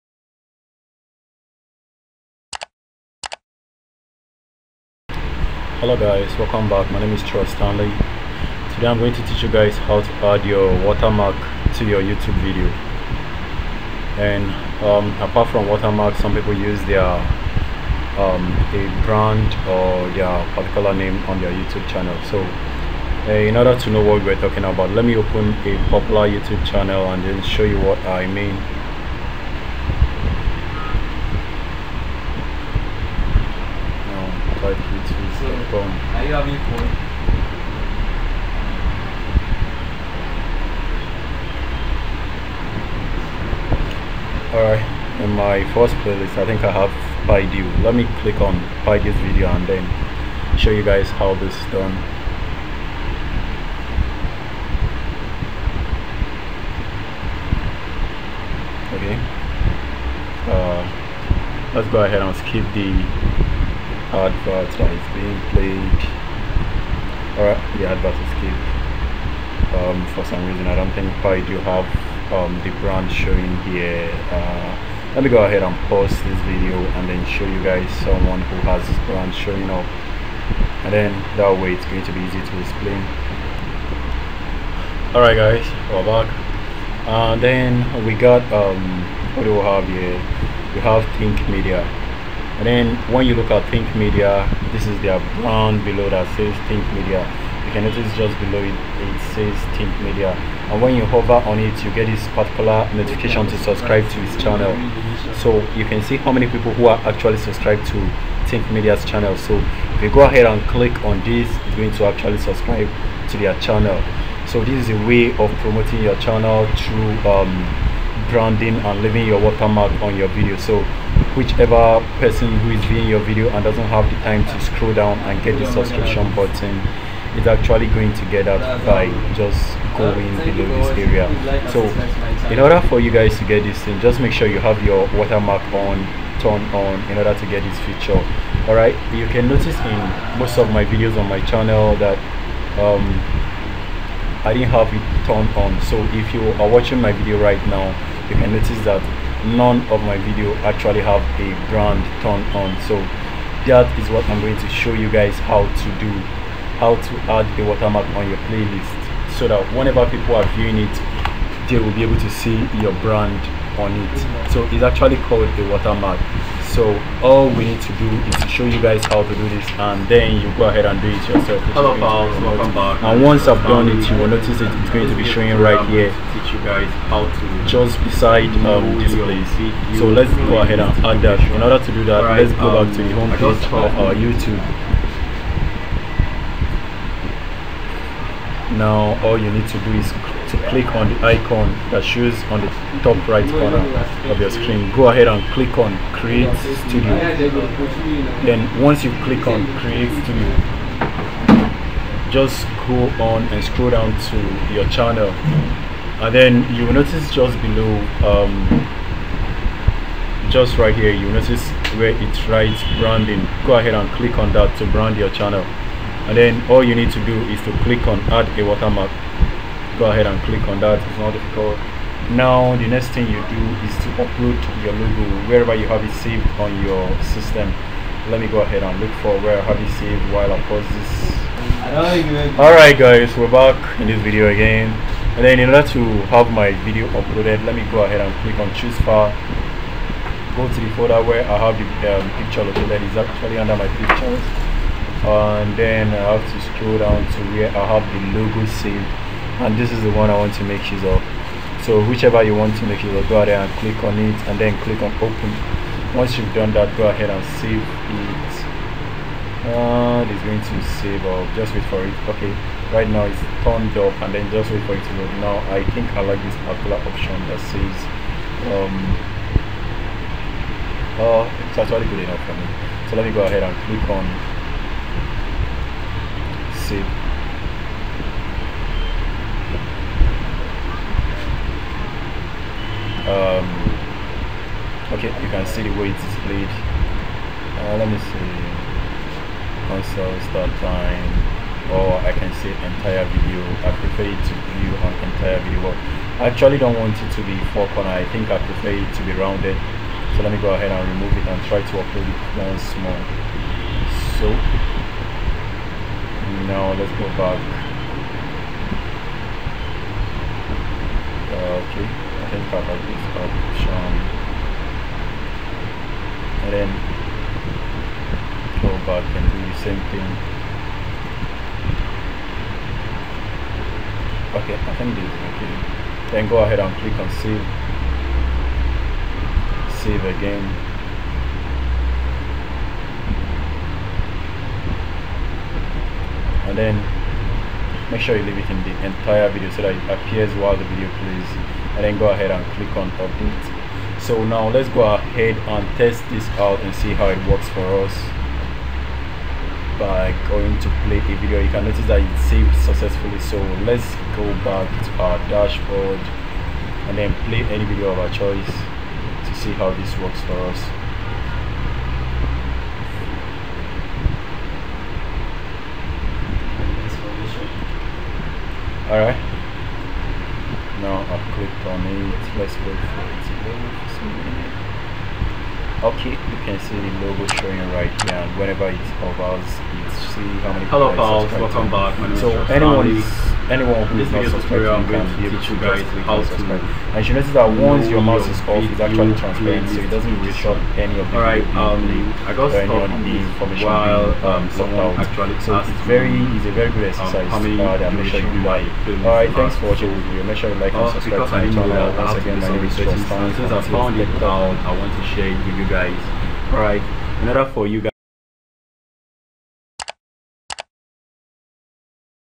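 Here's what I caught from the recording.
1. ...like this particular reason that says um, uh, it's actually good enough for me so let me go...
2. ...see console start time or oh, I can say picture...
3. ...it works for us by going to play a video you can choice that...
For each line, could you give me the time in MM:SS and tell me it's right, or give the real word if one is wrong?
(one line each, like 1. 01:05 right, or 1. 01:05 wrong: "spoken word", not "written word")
1. 04:26 wrong: "option", not "reason"
2. 04:48 wrong: "entire", not "picture"
3. 05:47 wrong: "notice", not "choice".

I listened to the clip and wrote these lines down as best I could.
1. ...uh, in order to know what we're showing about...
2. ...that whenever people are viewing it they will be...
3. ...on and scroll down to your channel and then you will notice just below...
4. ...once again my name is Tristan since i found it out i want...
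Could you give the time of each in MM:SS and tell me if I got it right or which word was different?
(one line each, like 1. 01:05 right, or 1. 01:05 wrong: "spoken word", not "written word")
1. 00:23 wrong: "talking", not "showing"
2. 02:39 right
3. 03:23 right
4. 06:42 right.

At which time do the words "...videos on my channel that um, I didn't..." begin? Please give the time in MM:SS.
02:20.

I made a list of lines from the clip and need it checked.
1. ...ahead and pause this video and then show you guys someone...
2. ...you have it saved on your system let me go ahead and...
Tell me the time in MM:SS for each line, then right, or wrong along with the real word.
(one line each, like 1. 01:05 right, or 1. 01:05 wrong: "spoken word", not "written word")
1. 01:15 right
2. 03:45 right.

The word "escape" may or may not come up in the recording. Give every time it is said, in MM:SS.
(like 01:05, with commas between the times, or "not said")
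01:08.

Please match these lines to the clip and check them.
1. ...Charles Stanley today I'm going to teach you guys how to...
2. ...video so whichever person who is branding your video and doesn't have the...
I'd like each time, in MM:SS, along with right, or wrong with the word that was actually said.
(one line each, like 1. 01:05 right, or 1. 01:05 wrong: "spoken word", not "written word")
1. 00:07 right
2. 02:00 wrong: "viewing", not "branding".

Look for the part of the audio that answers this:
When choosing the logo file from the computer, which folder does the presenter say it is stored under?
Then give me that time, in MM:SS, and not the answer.
04:03.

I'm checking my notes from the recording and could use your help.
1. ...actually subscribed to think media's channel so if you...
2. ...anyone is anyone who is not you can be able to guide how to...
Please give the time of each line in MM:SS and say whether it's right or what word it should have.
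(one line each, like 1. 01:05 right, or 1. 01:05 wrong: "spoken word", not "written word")
1. 01:47 right
2. 06:22 right.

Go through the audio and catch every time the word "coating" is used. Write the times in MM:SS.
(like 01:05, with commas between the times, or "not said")
not said.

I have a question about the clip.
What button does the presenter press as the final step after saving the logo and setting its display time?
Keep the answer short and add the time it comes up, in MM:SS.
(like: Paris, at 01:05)
Update, at 05:43.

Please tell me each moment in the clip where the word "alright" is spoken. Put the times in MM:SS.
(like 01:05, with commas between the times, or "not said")
00:44, 01:25, 03:52, 06:09.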